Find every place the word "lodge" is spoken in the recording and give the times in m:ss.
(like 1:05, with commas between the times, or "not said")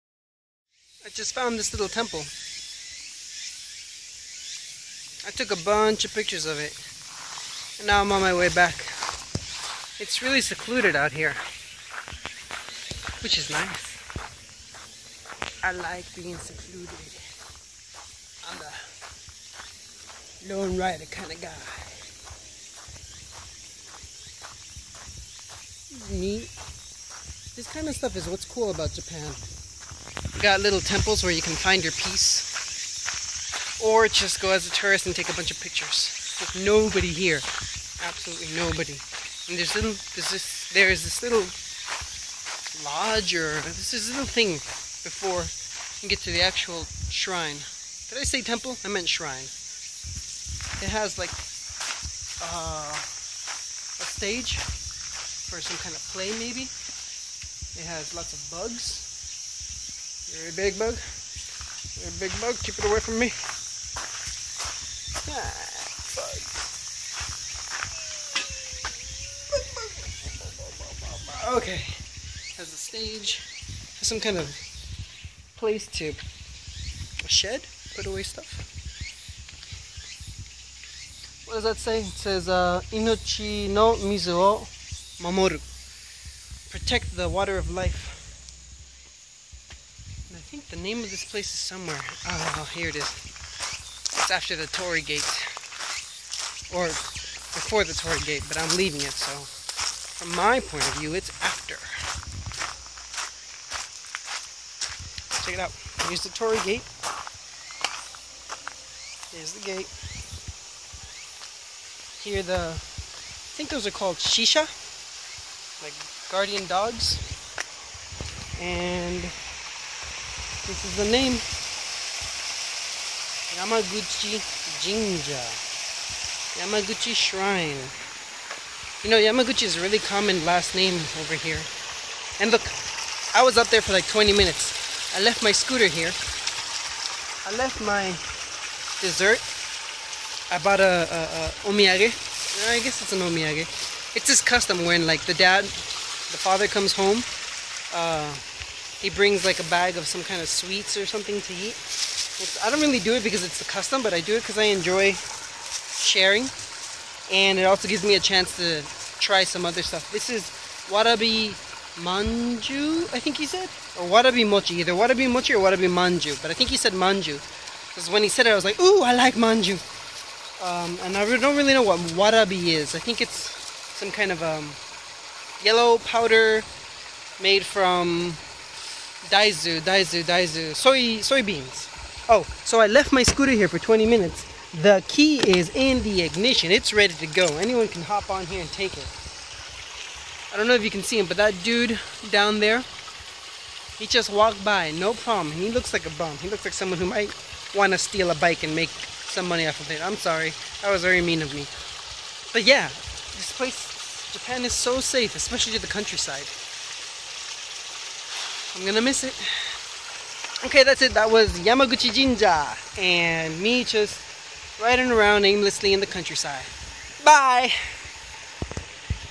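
0:42.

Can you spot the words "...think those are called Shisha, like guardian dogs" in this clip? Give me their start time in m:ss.
1:53.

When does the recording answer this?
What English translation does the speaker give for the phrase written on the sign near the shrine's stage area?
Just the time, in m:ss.
1:26.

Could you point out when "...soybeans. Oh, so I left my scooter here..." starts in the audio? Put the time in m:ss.
3:01.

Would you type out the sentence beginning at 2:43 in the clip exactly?
Or Warabi Mochi, either Warabi Mochi or Warabi Manju.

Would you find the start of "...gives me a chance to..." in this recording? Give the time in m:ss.
2:37.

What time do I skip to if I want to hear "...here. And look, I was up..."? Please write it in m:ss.
2:11.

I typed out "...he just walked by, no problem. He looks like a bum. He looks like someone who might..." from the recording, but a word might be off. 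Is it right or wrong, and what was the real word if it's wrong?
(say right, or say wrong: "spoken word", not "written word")
right.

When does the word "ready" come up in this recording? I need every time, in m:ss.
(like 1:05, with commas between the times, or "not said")
3:06.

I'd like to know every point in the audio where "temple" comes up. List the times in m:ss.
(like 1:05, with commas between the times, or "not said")
0:01, 0:30, 0:48.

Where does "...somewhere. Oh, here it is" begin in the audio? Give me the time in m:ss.
1:31.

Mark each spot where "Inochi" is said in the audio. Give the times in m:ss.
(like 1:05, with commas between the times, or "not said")
1:22.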